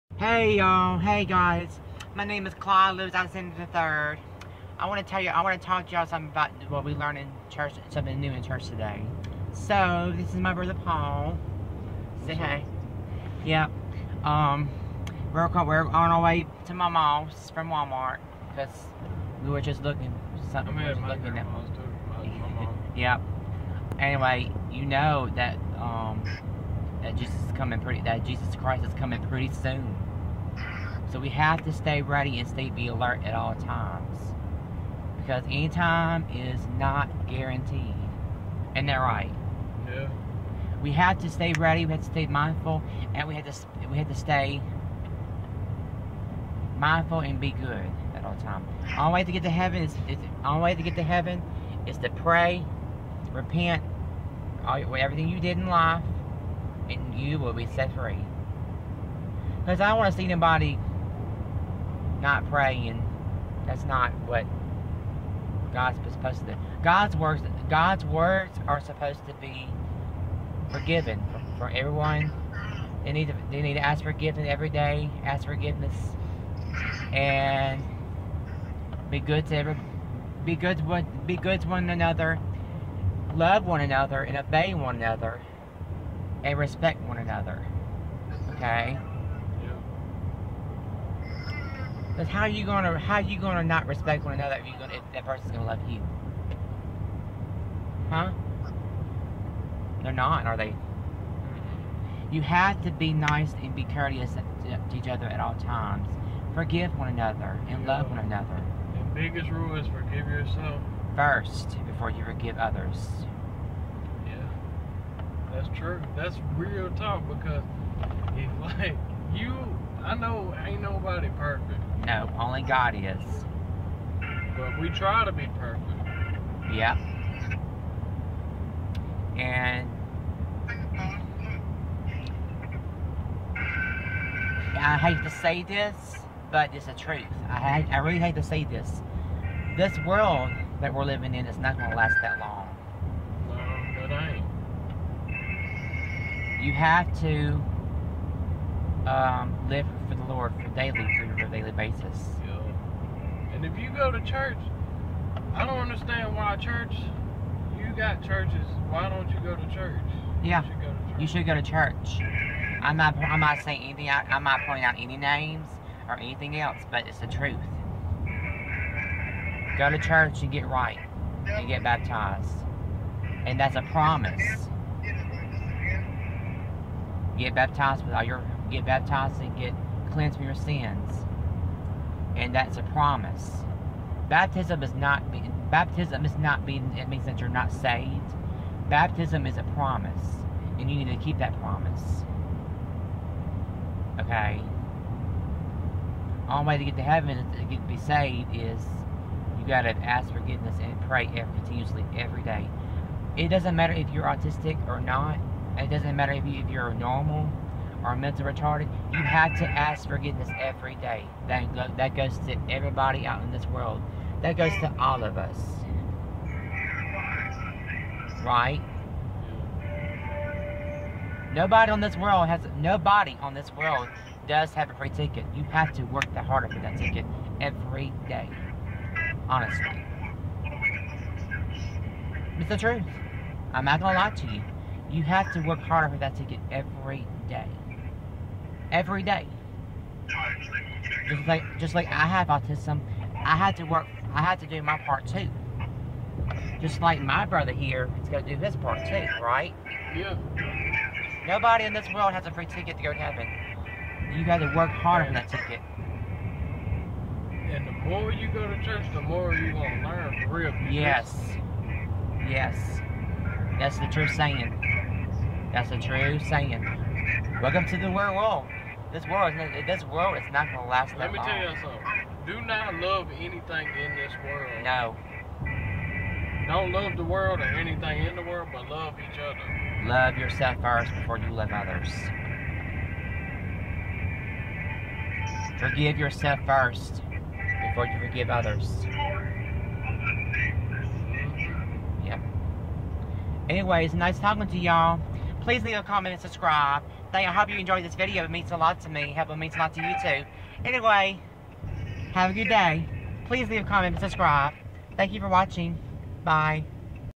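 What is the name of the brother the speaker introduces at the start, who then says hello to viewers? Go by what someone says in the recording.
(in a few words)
Paul.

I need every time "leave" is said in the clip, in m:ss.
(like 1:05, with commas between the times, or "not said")
4:55, 5:03.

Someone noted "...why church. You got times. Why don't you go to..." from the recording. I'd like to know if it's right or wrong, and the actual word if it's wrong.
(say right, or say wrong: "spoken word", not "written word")
wrong: "churches", not "times".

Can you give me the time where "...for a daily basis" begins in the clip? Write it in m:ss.
2:31.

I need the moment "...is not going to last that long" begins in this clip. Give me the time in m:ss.
2:21.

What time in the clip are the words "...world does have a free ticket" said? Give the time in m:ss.
3:43.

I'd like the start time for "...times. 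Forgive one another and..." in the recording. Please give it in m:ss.
1:45.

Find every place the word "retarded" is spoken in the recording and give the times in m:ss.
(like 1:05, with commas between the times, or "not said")
3:28.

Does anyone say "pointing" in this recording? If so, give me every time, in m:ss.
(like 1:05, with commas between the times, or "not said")
2:44.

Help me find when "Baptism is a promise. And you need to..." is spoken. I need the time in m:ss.
3:08.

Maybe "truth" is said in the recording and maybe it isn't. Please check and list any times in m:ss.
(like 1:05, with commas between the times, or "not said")
2:16, 2:47, 3:52.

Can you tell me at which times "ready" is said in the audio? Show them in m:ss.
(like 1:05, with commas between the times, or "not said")
0:32, 0:41.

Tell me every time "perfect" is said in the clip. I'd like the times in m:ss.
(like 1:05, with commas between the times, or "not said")
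2:01, 2:05.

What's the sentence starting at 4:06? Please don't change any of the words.
Just like my brother here, he's going to do his part too, right?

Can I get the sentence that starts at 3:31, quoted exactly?
That, go, that goes to everybody out in this world.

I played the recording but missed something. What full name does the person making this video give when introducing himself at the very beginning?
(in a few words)
Clyde Lewis.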